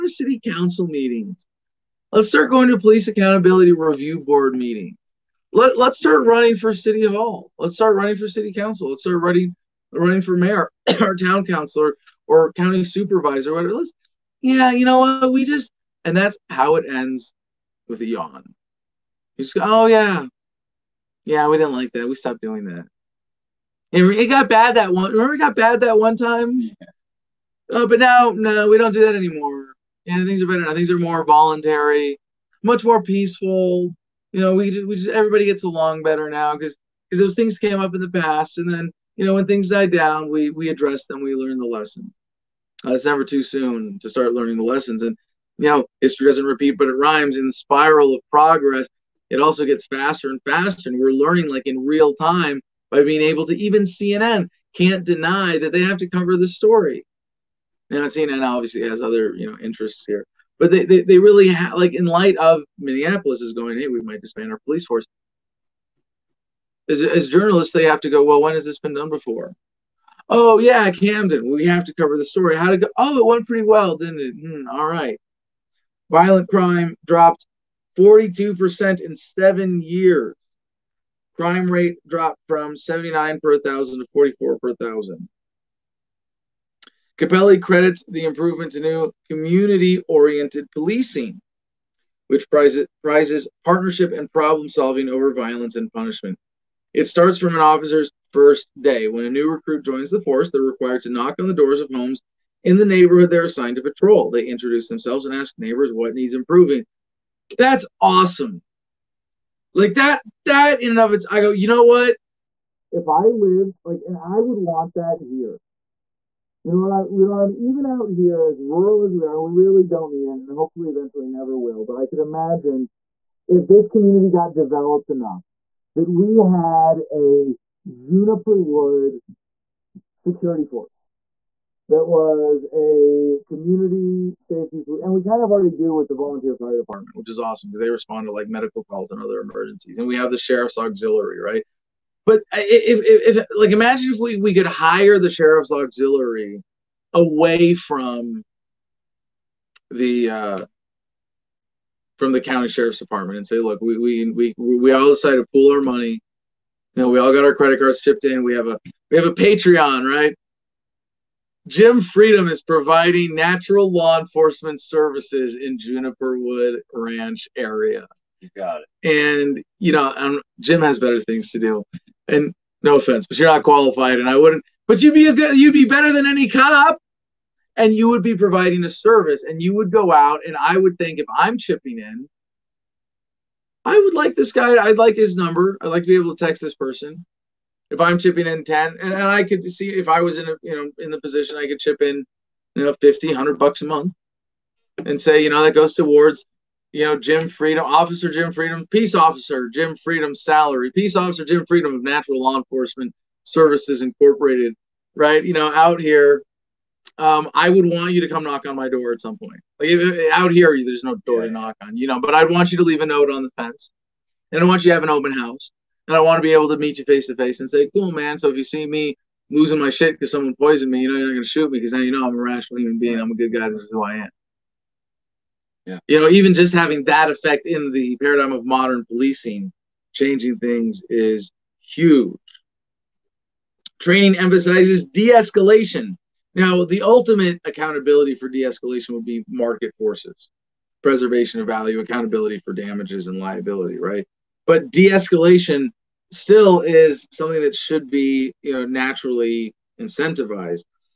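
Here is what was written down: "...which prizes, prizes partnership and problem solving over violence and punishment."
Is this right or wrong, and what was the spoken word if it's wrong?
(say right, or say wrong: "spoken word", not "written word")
right.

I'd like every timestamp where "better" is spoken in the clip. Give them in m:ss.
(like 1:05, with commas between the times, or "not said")
0:30, 0:36, 2:50, 2:55.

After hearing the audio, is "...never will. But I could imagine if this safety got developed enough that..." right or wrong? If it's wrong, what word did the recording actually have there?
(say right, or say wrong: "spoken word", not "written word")
wrong: "community", not "safety".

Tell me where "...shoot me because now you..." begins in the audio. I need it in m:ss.
3:41.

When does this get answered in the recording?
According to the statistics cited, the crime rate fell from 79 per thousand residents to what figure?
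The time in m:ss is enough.
1:24.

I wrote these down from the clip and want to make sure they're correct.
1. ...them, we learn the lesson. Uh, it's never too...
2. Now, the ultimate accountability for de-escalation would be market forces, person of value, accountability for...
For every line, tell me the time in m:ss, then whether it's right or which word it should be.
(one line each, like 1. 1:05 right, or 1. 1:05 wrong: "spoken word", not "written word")
1. 0:41 right
2. 3:56 wrong: "preservation", not "person".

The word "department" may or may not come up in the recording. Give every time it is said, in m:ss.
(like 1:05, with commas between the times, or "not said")
2:16, 2:32.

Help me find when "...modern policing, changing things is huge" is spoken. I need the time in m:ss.
3:48.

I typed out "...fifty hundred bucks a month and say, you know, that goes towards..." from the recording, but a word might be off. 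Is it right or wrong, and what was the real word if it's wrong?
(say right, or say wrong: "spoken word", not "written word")
right.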